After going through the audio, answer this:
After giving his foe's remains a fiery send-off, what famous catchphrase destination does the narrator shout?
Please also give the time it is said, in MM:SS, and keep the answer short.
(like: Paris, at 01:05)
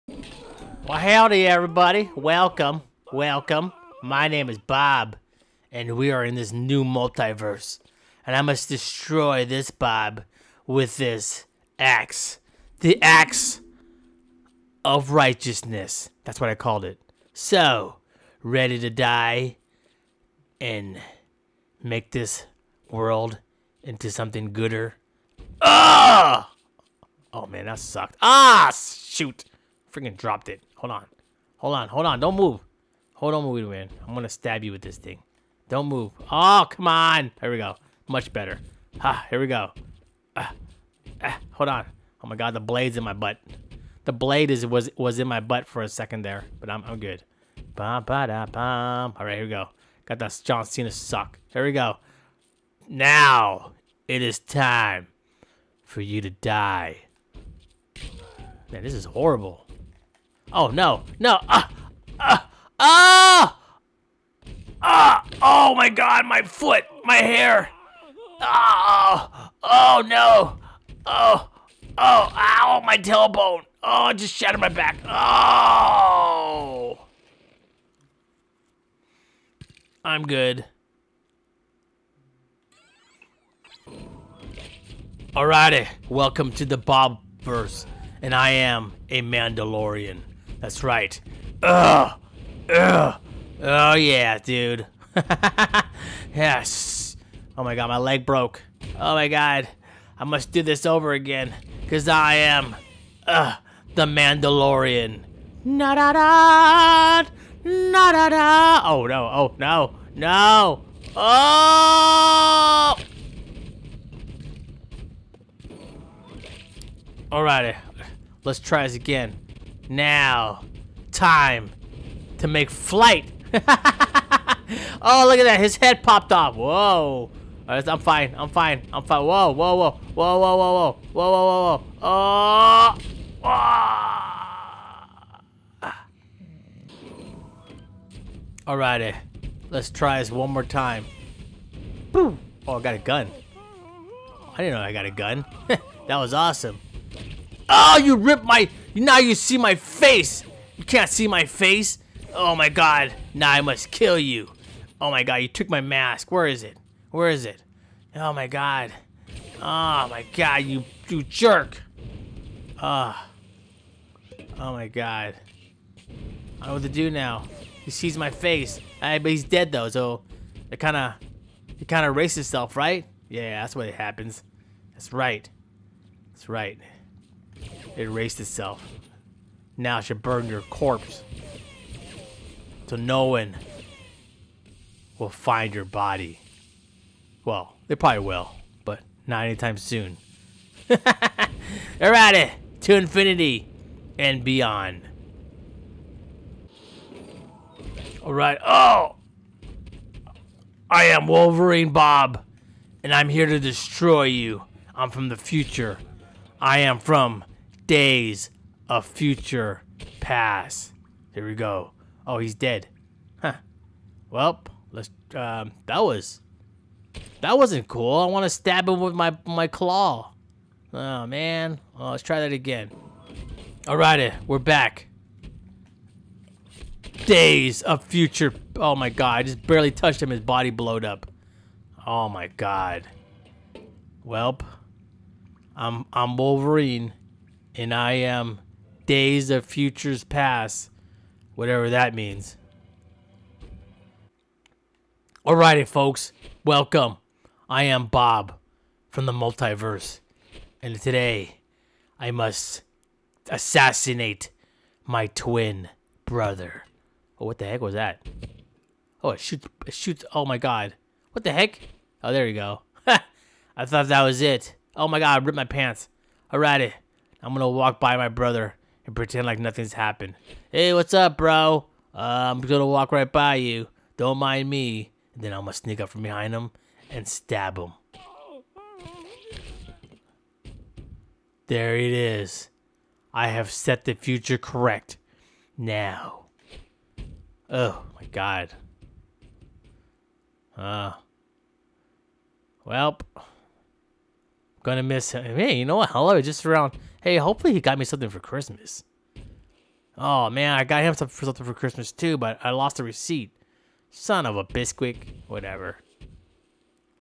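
infinity and beyond, at 03:12.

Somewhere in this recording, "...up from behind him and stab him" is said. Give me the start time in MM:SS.
04:35.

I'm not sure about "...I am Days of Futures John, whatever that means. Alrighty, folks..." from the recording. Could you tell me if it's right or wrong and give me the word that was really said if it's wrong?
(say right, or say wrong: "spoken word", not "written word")
wrong: "Past", not "John".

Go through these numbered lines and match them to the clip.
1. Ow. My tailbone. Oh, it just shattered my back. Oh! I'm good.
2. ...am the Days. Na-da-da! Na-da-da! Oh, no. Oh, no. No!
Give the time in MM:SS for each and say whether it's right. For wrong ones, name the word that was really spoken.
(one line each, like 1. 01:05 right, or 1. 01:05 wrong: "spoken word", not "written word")
1. 01:12 right
2. 01:42 wrong: "Mandalorian", not "Days".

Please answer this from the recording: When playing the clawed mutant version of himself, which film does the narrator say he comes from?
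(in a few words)
Days of Future Past.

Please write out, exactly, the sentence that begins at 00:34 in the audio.
I'm going to stab you with this thing.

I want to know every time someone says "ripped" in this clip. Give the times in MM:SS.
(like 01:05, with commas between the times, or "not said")
02:28, 04:25.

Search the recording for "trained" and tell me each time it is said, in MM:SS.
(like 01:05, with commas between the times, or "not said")
not said.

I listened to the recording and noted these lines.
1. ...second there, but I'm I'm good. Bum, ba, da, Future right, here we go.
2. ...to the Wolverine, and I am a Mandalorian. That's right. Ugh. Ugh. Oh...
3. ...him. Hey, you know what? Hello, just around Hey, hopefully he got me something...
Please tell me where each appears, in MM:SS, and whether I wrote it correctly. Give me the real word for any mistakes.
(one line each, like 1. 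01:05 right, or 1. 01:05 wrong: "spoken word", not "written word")
1. 00:45 wrong: "All", not "Future"
2. 01:26 wrong: "Bobverse", not "Wolverine"
3. 04:55 right.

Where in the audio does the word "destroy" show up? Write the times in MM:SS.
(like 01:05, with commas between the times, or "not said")
00:08, 03:23.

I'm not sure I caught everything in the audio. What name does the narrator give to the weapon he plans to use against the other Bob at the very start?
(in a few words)
The axe of righteousness.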